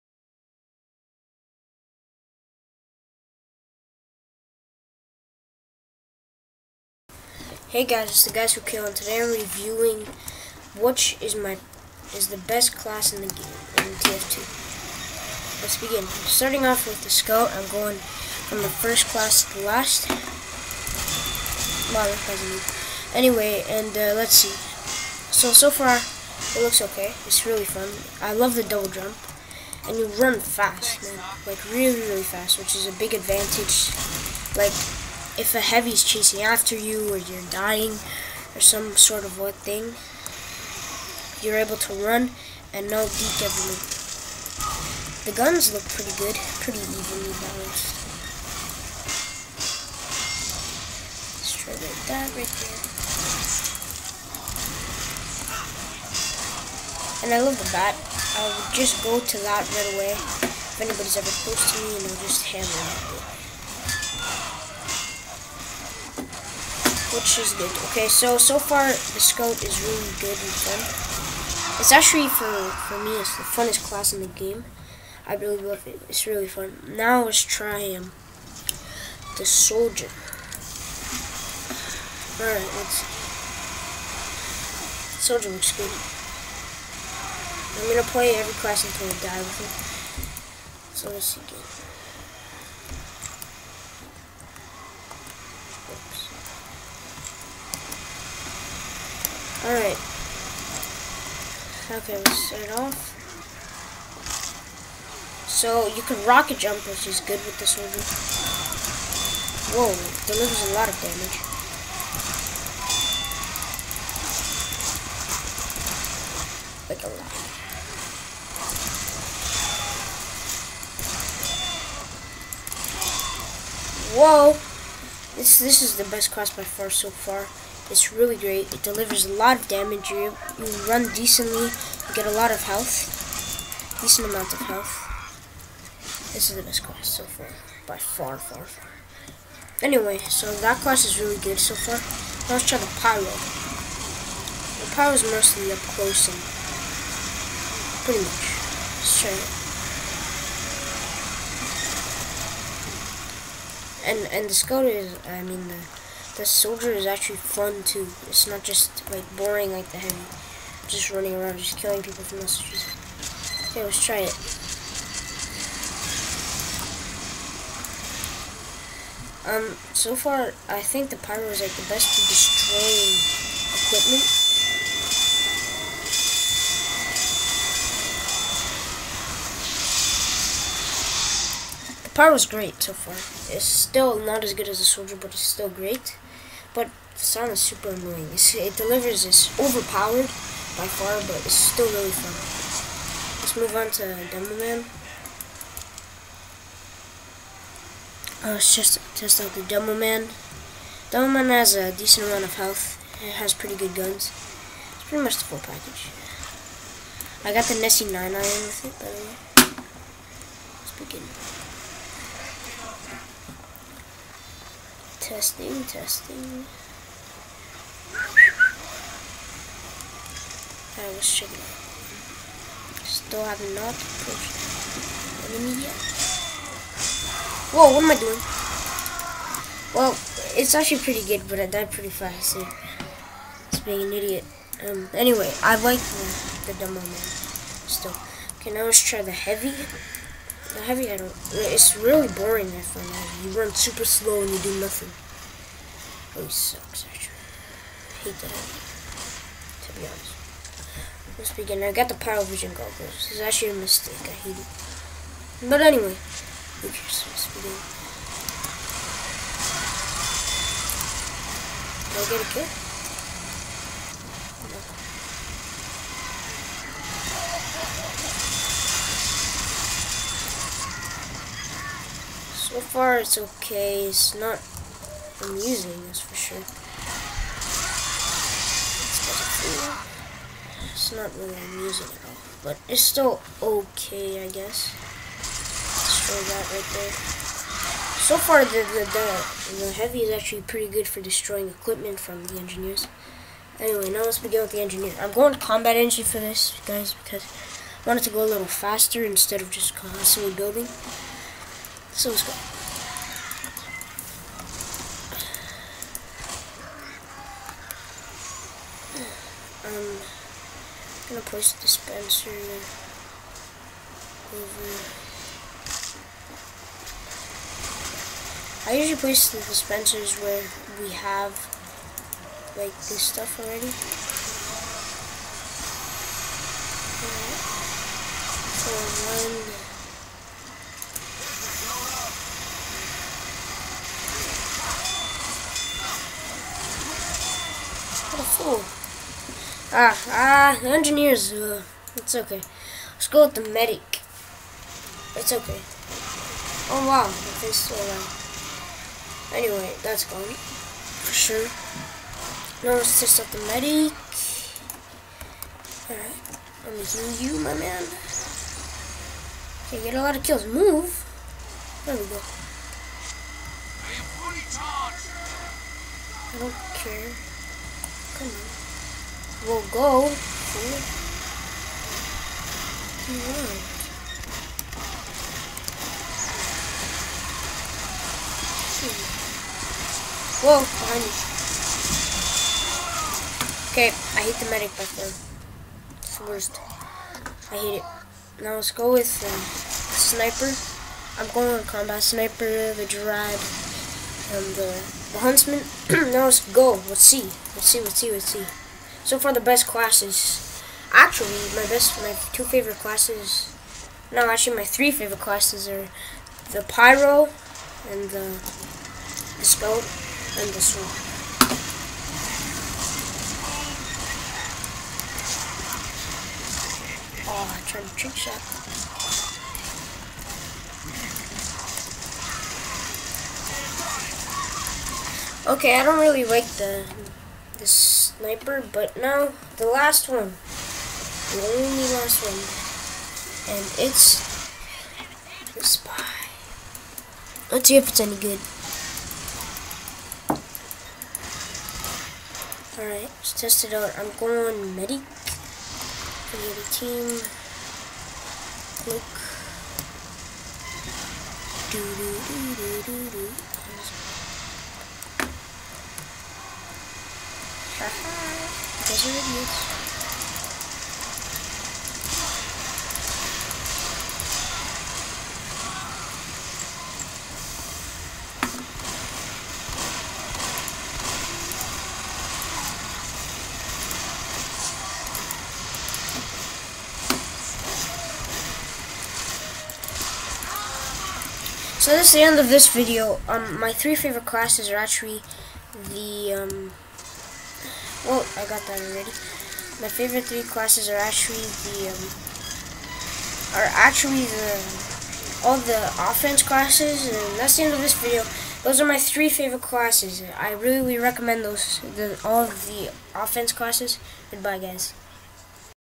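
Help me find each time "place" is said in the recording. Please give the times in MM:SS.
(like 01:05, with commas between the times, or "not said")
05:11, 05:19.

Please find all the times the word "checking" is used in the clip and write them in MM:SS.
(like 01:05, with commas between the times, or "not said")
03:41.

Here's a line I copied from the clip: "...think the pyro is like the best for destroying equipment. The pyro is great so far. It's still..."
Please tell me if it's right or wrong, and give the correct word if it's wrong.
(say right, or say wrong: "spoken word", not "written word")
right.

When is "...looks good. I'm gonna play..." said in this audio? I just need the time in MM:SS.
01:25.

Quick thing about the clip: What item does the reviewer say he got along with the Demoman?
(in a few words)
Nessie 9 iron.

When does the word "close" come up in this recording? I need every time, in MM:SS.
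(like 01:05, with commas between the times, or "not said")
01:01, 02:25.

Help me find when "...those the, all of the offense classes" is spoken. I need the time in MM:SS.
08:21.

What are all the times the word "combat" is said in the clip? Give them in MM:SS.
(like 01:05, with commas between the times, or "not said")
04:55, 06:31.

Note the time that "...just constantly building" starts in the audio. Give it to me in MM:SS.
04:59.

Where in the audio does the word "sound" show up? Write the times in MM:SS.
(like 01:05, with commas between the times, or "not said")
03:07.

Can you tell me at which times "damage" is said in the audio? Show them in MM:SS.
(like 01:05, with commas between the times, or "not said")
01:50, 02:09.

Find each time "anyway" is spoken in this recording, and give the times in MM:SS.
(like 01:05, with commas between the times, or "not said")
00:23, 02:19, 03:55, 04:15, 04:53, 05:49.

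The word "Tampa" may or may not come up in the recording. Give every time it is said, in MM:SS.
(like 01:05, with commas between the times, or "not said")
not said.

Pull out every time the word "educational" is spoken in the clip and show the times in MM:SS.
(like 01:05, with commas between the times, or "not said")
not said.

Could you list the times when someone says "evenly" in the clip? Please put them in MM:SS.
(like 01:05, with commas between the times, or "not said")
00:46.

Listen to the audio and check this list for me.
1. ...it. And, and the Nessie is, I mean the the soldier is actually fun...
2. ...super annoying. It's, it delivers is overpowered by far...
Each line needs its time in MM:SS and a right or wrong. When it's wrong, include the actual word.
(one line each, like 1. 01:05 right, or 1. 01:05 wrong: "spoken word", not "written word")
1. 02:34 wrong: "Skoda", not "Nessie"
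2. 03:07 right.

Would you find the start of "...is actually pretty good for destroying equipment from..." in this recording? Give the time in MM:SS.
04:50.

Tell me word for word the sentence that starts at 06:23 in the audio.
Okay, I hate the medic button.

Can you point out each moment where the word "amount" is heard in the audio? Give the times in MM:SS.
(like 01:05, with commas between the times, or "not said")
02:14, 03:22.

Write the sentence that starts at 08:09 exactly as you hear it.
My favorite three classes are actually the um, are actually the all the offense classes.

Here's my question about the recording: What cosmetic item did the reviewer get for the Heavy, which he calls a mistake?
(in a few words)
Pyro Vision goggles.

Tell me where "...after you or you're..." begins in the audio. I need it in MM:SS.
00:36.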